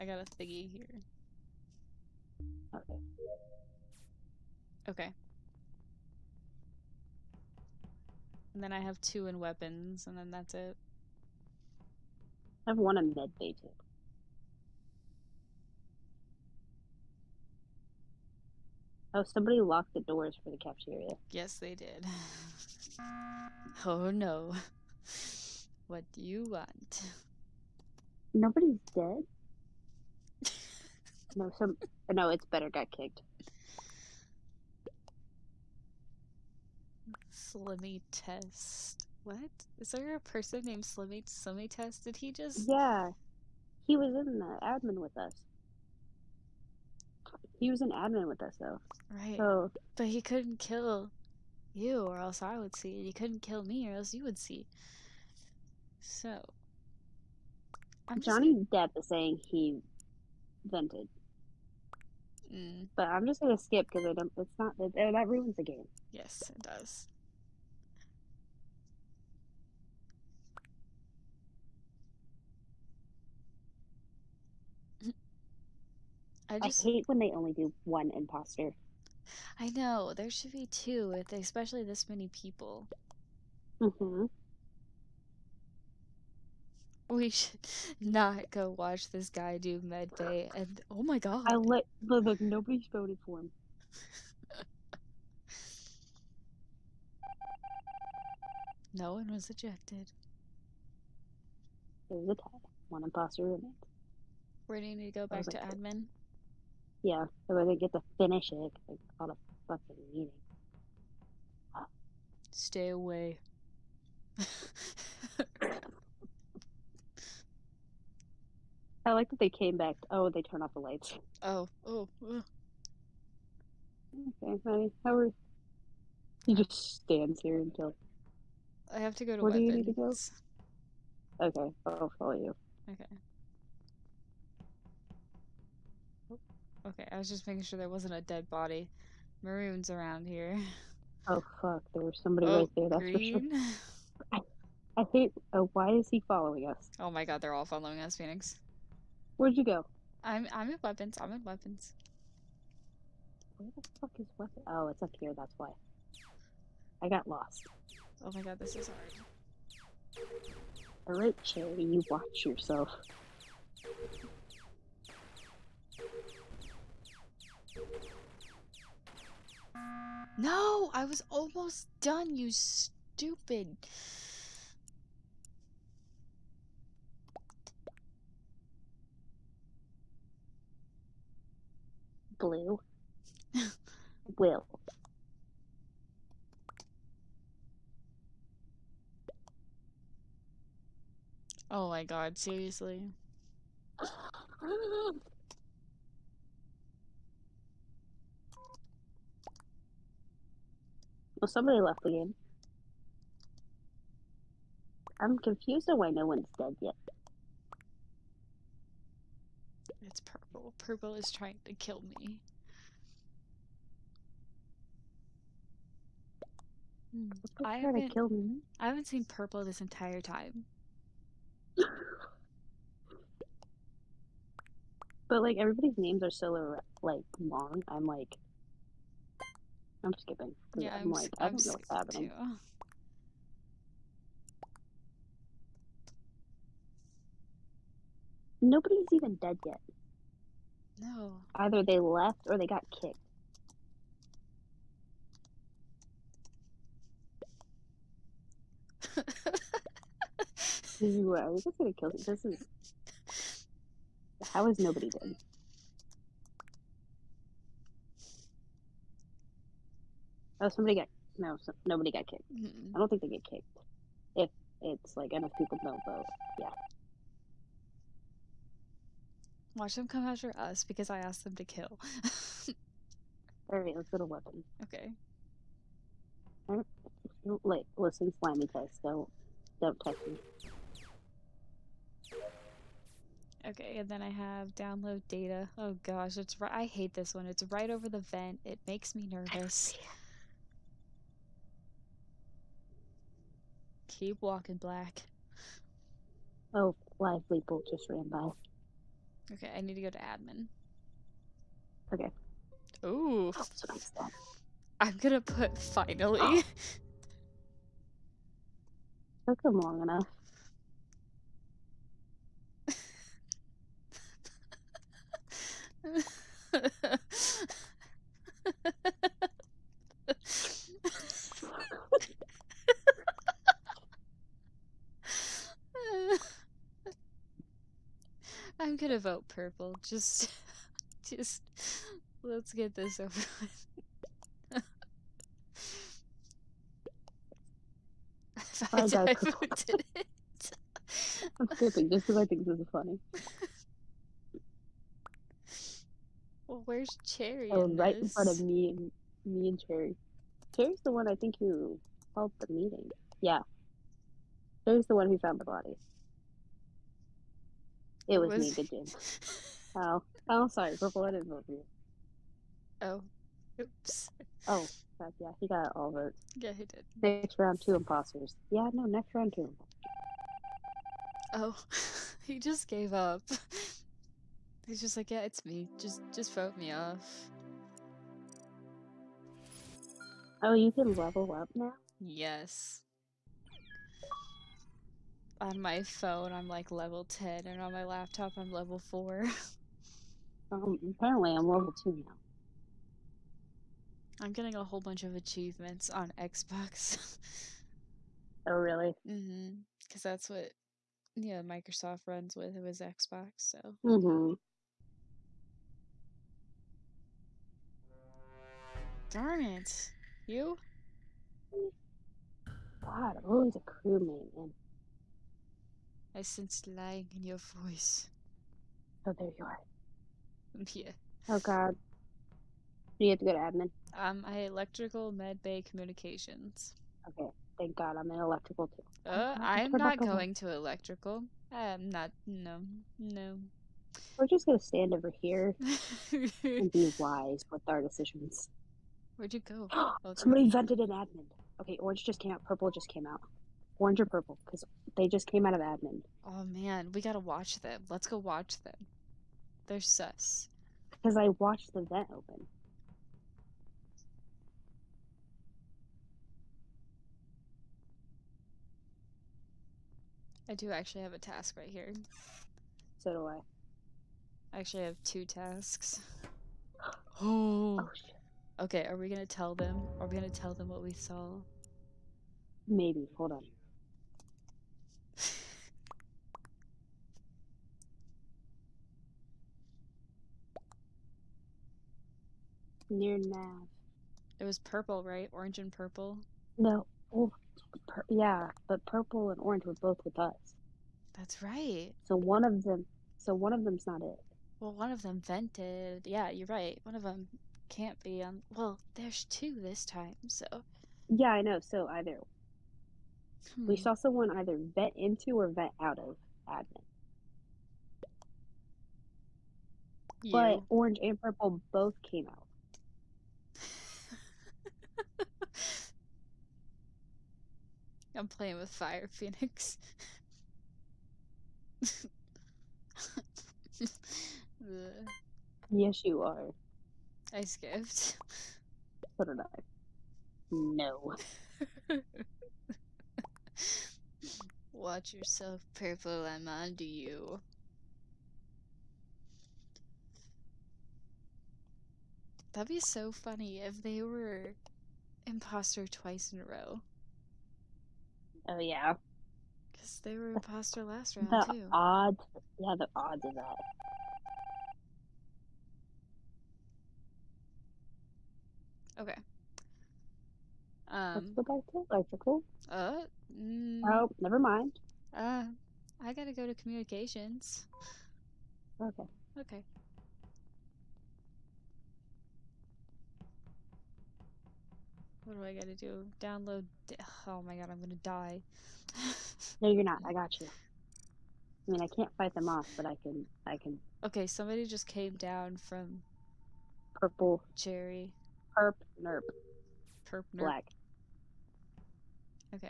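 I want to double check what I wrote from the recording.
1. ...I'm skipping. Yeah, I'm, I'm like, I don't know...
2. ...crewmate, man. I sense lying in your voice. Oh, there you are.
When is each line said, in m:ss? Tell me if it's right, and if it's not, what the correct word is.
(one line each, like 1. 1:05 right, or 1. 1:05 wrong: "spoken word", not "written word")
1. 3:50 right
2. 6:53 right.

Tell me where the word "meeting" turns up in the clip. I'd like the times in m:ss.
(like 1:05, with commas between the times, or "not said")
1:50, 5:52.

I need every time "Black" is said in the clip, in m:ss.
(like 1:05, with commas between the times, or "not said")
4:54, 9:50.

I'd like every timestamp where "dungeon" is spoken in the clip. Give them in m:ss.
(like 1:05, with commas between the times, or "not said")
not said.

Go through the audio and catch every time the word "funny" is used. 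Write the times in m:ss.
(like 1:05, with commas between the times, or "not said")
5:42, 9:03.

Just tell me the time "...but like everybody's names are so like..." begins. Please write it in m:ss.
3:45.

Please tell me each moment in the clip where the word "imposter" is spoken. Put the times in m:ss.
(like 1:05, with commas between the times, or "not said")
1:18, 1:43, 6:07, 9:05, 9:10.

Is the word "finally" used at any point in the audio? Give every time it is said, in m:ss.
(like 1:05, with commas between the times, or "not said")
5:05.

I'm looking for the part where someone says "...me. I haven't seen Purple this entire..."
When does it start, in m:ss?
3:38.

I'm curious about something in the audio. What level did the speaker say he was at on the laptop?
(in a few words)
4.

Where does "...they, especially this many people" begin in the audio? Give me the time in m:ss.
1:21.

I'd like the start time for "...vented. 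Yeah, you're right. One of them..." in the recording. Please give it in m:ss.
8:15.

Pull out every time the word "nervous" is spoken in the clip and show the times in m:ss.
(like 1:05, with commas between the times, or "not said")
4:49.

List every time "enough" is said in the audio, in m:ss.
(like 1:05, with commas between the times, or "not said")
4:25, 5:10.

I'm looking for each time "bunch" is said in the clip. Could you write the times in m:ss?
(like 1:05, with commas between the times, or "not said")
6:35.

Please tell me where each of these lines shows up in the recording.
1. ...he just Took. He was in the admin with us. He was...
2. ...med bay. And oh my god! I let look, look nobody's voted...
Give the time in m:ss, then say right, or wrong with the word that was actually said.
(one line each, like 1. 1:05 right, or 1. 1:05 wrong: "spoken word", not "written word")
1. 0:42 wrong: "Yeah", not "Took"
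2. 1:29 right.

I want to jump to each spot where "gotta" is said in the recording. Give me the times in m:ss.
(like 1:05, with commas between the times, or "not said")
7:27, 9:26, 9:35.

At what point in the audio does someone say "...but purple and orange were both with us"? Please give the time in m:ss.
8:08.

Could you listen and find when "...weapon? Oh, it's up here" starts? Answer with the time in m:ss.
2:34.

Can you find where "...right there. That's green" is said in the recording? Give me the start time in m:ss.
2:22.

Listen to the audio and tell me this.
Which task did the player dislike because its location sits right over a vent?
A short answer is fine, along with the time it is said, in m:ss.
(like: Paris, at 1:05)
Download data, at 4:44.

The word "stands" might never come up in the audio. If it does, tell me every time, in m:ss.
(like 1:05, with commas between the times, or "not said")
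2:07, 7:14.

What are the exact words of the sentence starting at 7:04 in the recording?
Um, I electrical med bay communications.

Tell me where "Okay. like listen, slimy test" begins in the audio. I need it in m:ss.
4:34.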